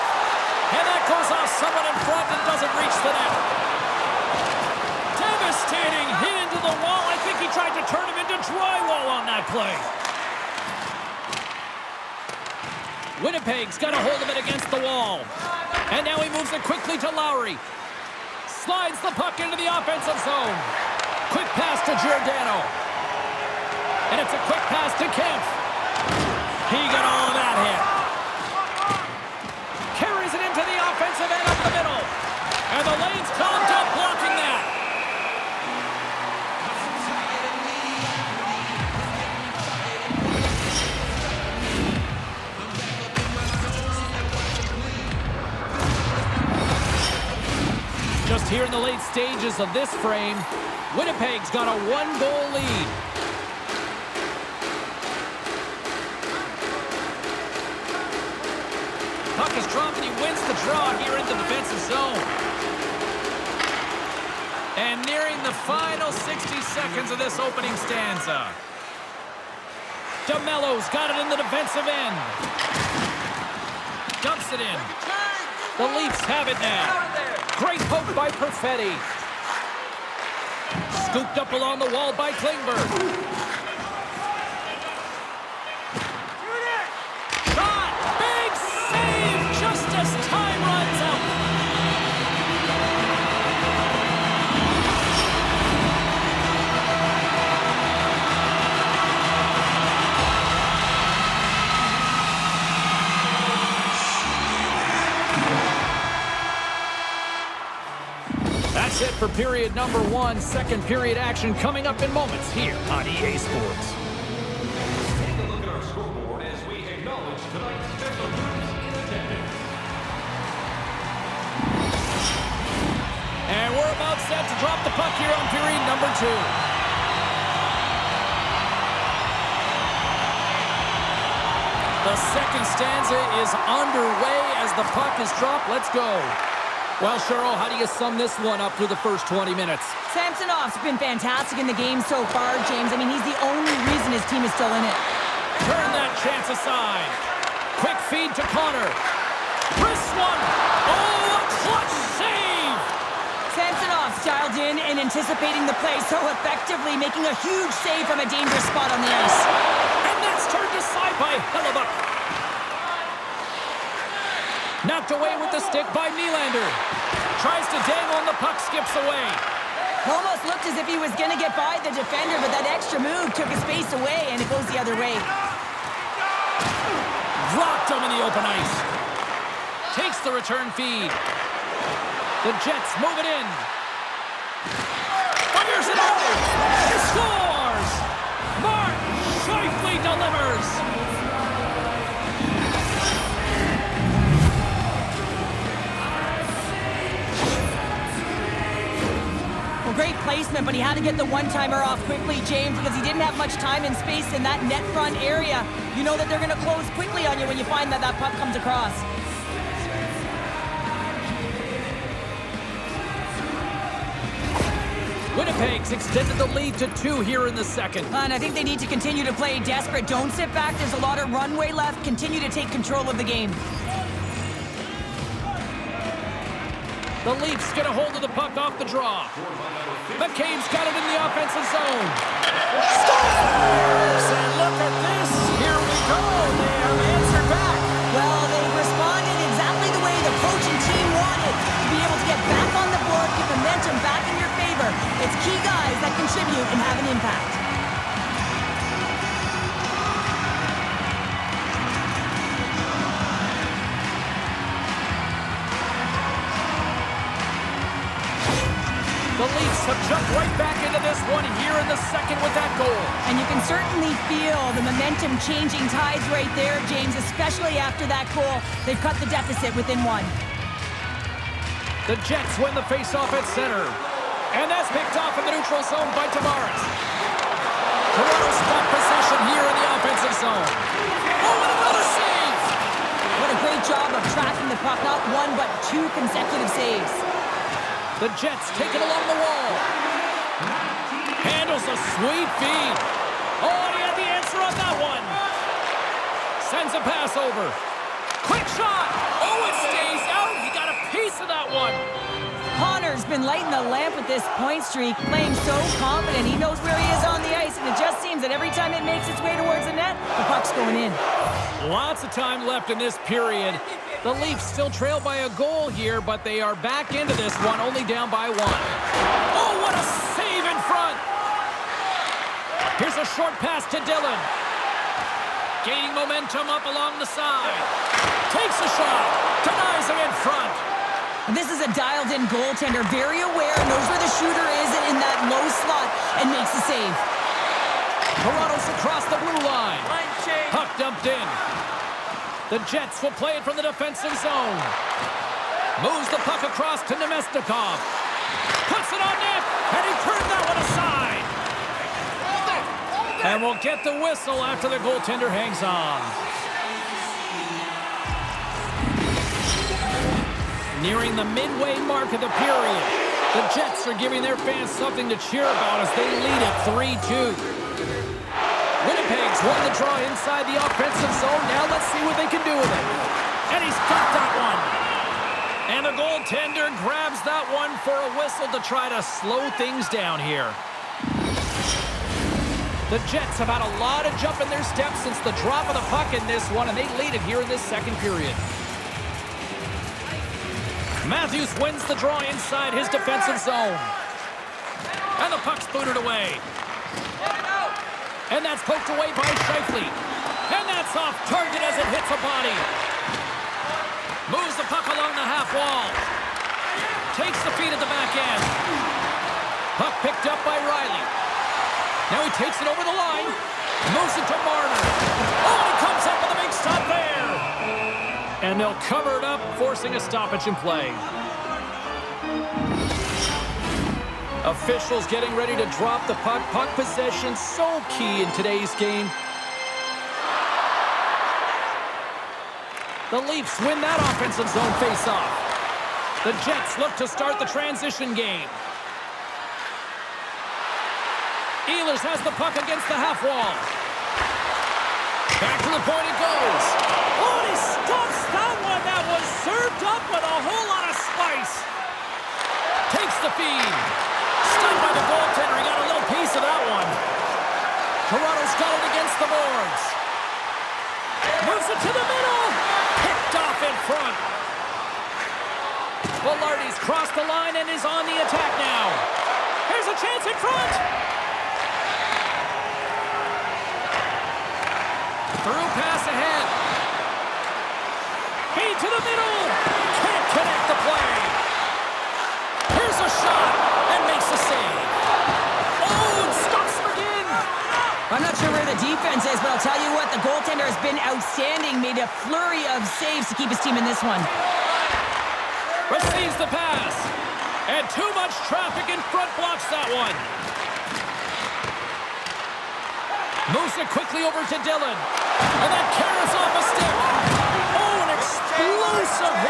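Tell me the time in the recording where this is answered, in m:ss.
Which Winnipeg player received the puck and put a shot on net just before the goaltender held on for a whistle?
5:47.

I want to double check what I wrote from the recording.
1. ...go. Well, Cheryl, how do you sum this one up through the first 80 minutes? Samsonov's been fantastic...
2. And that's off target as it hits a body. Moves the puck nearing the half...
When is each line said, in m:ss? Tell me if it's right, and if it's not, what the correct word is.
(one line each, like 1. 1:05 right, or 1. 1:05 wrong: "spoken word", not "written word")
1. 2:15 wrong: "20", not "80"
2. 6:40 wrong: "along", not "nearing".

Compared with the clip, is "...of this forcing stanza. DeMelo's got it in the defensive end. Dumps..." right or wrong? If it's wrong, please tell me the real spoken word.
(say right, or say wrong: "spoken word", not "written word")
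wrong: "opening", not "forcing".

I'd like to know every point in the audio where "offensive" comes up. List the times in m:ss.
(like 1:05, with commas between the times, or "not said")
0:19, 0:30, 3:51, 4:40, 6:10, 7:14.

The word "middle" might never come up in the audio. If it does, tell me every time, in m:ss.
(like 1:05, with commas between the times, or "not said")
0:31, 7:42, 7:59.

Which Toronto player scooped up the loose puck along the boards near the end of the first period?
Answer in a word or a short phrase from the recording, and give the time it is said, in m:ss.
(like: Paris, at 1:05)
Klingberg, at 1:22.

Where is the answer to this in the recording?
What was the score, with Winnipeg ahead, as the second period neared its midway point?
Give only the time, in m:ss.
6:07.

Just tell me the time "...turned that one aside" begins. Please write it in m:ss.
5:50.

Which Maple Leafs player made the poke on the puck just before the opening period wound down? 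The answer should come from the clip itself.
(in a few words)
Perfetti.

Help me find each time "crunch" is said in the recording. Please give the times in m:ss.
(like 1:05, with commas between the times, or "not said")
not said.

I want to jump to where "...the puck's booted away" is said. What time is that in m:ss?
6:35.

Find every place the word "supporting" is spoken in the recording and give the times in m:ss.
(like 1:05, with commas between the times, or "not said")
not said.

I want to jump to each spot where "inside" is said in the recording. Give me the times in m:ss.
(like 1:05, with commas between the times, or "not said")
6:10, 6:32.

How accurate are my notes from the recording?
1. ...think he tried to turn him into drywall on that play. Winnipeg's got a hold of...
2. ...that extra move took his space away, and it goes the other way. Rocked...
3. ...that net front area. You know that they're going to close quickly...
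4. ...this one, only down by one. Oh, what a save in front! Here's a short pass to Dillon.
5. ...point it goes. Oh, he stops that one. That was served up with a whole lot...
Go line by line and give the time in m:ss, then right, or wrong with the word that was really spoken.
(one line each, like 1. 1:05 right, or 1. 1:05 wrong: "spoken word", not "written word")
1. 0:07 right
2. 2:52 right
3. 3:24 right
4. 5:17 right
5. 7:26 right.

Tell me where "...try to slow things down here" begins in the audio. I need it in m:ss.
6:18.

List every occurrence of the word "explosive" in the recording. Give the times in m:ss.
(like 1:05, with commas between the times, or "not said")
8:28.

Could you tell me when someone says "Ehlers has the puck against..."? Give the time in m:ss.
7:21.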